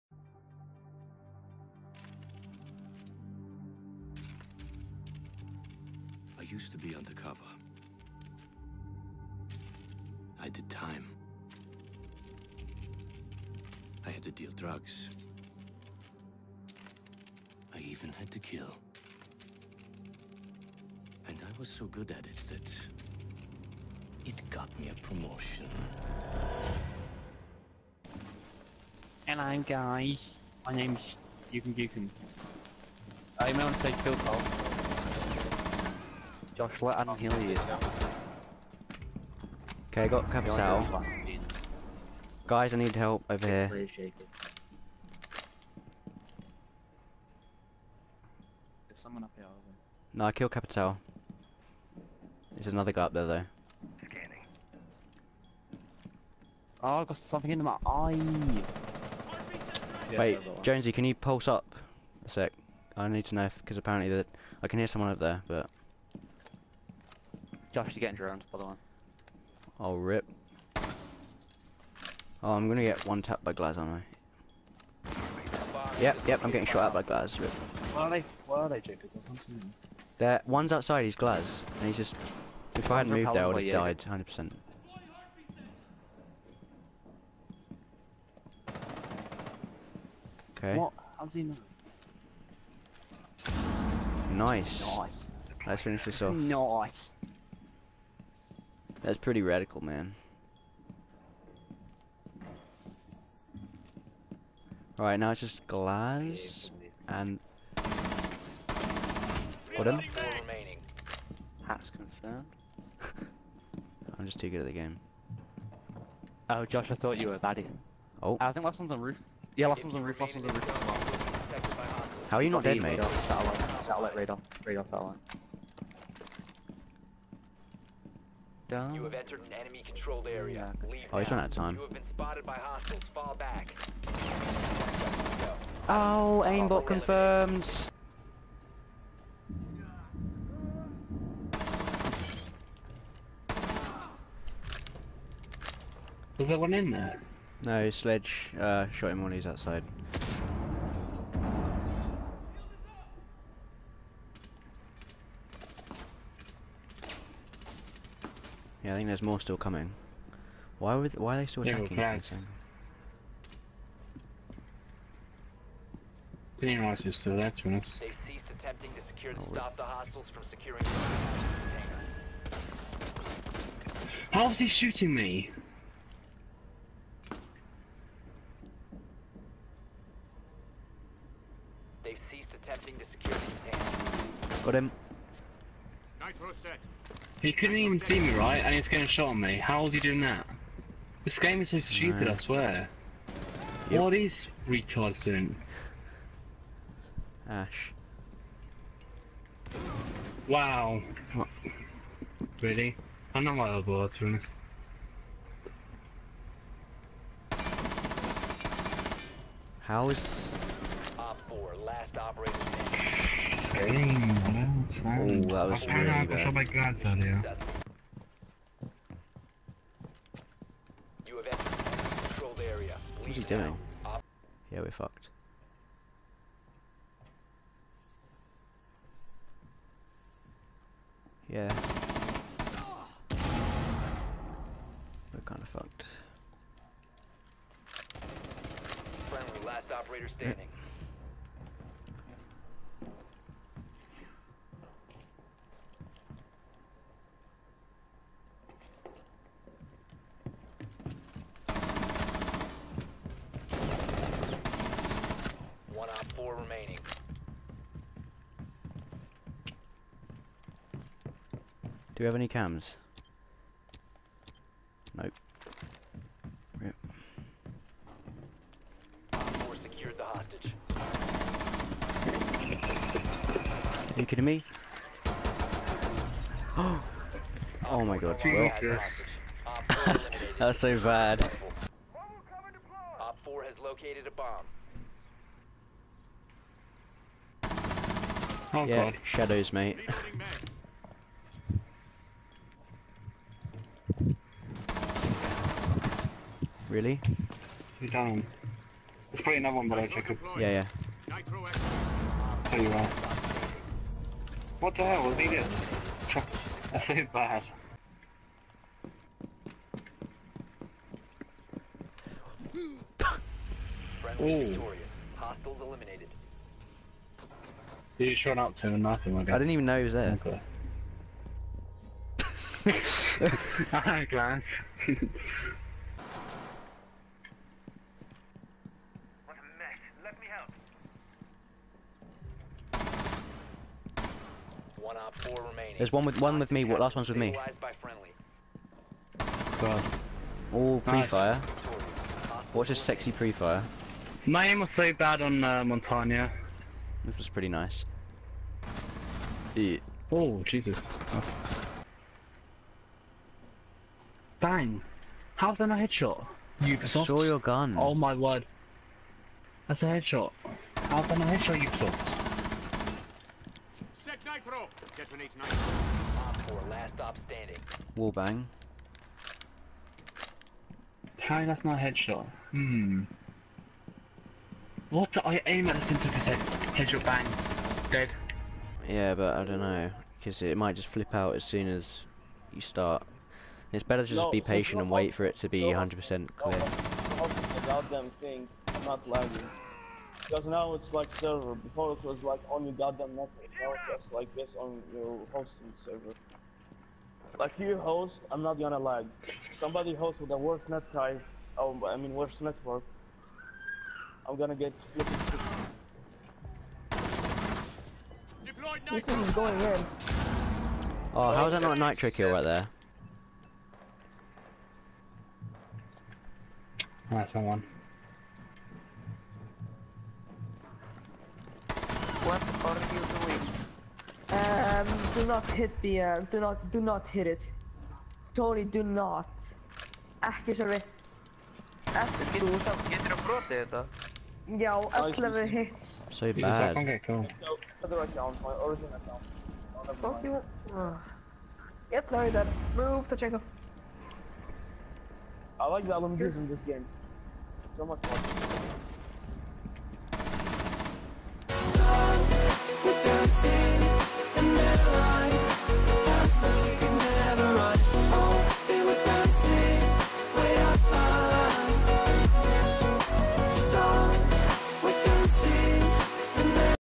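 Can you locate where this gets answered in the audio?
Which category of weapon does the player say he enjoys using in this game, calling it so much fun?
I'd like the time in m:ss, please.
7:26.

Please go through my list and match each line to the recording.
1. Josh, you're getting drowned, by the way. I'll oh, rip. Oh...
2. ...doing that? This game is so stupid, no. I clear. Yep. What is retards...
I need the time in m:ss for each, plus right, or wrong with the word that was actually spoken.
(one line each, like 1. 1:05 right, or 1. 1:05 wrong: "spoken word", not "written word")
1. 1:07 right
2. 3:09 wrong: "swear", not "clear".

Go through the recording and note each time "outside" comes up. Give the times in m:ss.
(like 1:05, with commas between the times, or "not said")
1:20, 2:29.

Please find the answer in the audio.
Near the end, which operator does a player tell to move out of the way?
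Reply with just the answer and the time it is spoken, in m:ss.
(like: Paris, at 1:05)
Tachanka, at 7:23.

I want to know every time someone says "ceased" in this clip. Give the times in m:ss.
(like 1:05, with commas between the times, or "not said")
2:47, 3:02.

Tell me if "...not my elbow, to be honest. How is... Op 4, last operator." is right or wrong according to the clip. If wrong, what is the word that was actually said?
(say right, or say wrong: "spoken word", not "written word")
right.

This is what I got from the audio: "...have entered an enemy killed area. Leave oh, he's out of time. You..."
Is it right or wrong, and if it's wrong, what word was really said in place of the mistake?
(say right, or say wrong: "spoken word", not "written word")
wrong: "controlled", not "killed".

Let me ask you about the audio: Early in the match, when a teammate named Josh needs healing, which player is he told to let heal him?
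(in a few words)
Adam.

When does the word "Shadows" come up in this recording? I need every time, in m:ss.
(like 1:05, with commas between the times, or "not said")
4:49.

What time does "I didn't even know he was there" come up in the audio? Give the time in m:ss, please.
5:19.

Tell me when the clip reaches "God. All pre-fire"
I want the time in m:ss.
5:39.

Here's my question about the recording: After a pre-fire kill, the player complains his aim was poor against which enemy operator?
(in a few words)
Montagne.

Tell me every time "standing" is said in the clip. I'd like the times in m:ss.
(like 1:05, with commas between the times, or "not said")
4:00, 6:07.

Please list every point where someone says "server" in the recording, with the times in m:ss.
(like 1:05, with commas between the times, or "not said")
6:31, 6:36.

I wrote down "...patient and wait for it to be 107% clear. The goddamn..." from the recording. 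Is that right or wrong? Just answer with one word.
wrong.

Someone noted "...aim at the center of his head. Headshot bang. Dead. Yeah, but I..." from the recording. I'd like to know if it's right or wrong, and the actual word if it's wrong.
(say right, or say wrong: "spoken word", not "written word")
right.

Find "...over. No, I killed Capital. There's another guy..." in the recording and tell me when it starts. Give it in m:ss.
0:49.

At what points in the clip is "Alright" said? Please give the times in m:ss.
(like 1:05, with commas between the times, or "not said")
1:44, 6:57.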